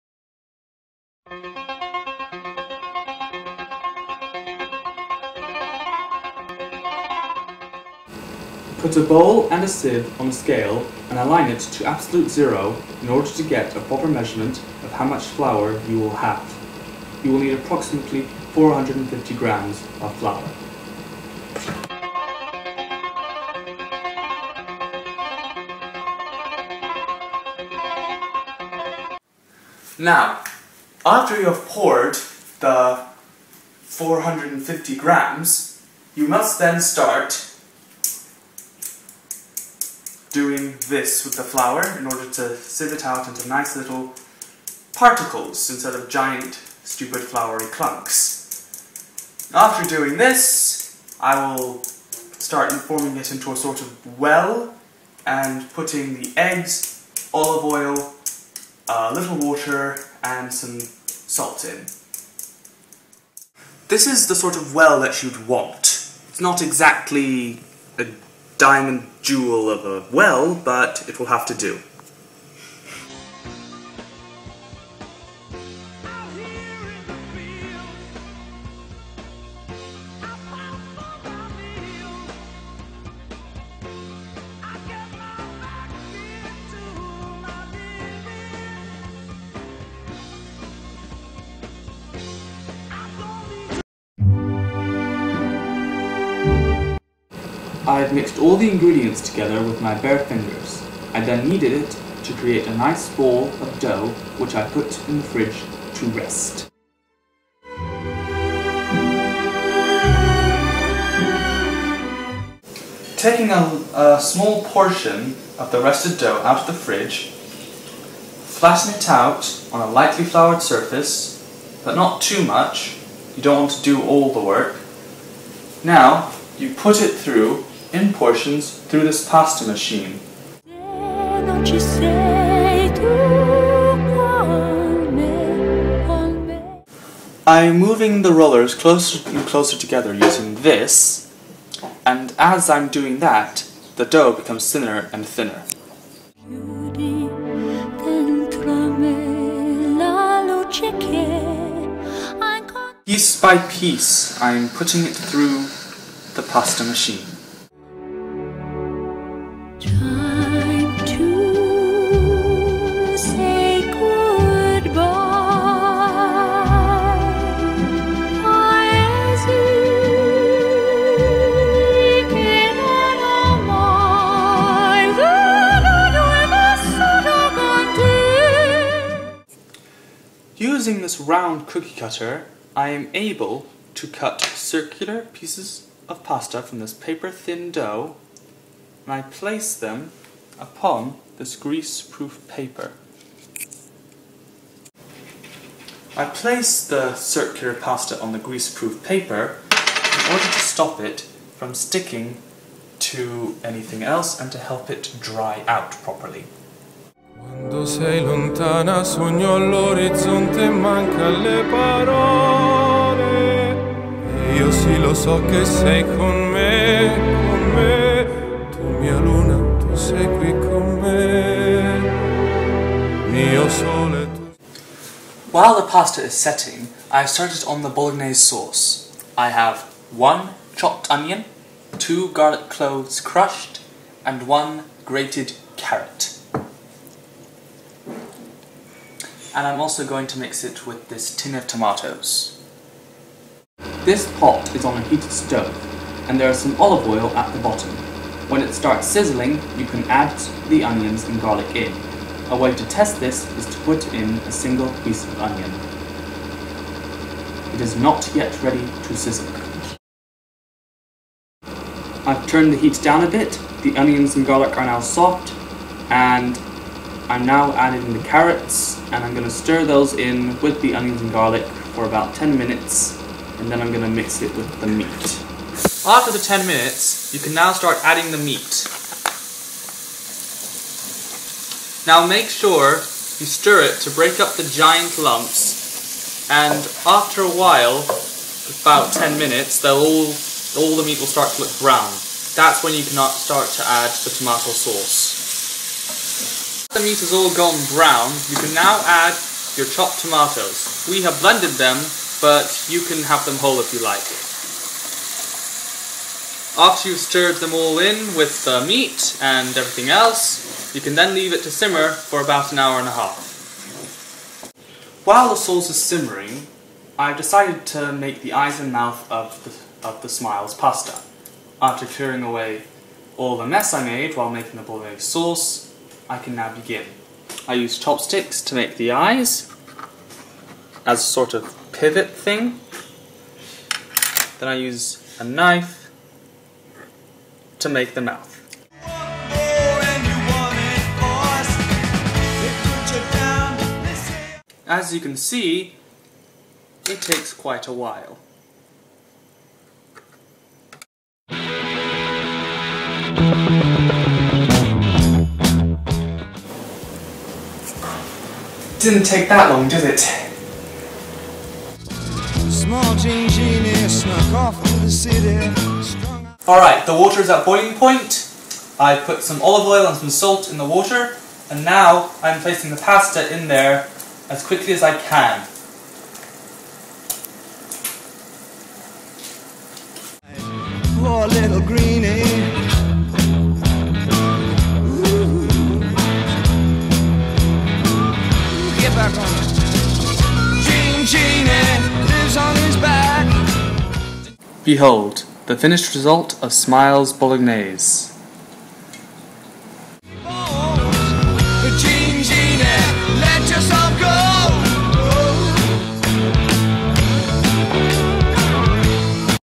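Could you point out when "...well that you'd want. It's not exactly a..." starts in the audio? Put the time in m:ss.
1:04.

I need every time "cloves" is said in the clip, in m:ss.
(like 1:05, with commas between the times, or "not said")
3:52.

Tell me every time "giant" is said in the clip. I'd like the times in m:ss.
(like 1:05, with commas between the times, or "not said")
0:46, 4:44.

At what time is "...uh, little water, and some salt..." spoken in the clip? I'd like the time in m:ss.
0:58.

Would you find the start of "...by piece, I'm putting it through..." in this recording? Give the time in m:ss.
2:33.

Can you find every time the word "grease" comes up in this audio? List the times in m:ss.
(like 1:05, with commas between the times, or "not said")
3:11, 3:18.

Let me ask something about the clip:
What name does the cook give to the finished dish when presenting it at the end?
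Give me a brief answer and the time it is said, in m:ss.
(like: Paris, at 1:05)
Smiles Bolognese, at 6:36.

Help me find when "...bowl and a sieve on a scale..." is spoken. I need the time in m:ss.
0:09.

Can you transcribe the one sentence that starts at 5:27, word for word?
I use chopsticks to make the eyes as a sort of pivot thing.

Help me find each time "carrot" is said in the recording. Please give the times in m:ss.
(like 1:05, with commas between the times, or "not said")
3:55, 4:28.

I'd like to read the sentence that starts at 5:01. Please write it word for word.
We have blended them, but you can have them whole if you like.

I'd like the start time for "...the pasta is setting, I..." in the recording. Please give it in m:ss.
3:45.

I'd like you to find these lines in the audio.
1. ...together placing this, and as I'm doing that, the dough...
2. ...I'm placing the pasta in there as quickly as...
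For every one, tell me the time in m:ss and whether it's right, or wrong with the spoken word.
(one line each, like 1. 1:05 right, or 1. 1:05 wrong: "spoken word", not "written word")
1. 2:19 wrong: "using", not "placing"
2. 6:12 right.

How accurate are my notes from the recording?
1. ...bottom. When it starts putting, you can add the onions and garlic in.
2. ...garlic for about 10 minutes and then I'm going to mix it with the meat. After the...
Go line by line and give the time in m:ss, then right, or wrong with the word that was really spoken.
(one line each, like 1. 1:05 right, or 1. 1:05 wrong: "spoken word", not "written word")
1. 4:07 wrong: "sizzling", not "putting"
2. 4:31 right.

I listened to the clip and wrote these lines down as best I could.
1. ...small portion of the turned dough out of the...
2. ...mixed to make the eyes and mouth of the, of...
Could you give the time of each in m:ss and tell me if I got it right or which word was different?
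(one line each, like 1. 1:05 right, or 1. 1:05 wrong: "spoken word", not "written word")
1. 1:54 wrong: "rested", not "turned"
2. 5:17 wrong: "decided", not "mixed".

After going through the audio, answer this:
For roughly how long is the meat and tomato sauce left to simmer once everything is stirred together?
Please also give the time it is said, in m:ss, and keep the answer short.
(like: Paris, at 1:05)
an hour and a half, at 5:12.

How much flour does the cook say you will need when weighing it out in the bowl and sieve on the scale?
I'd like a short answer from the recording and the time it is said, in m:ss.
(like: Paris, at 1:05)
450 grams, at 0:17.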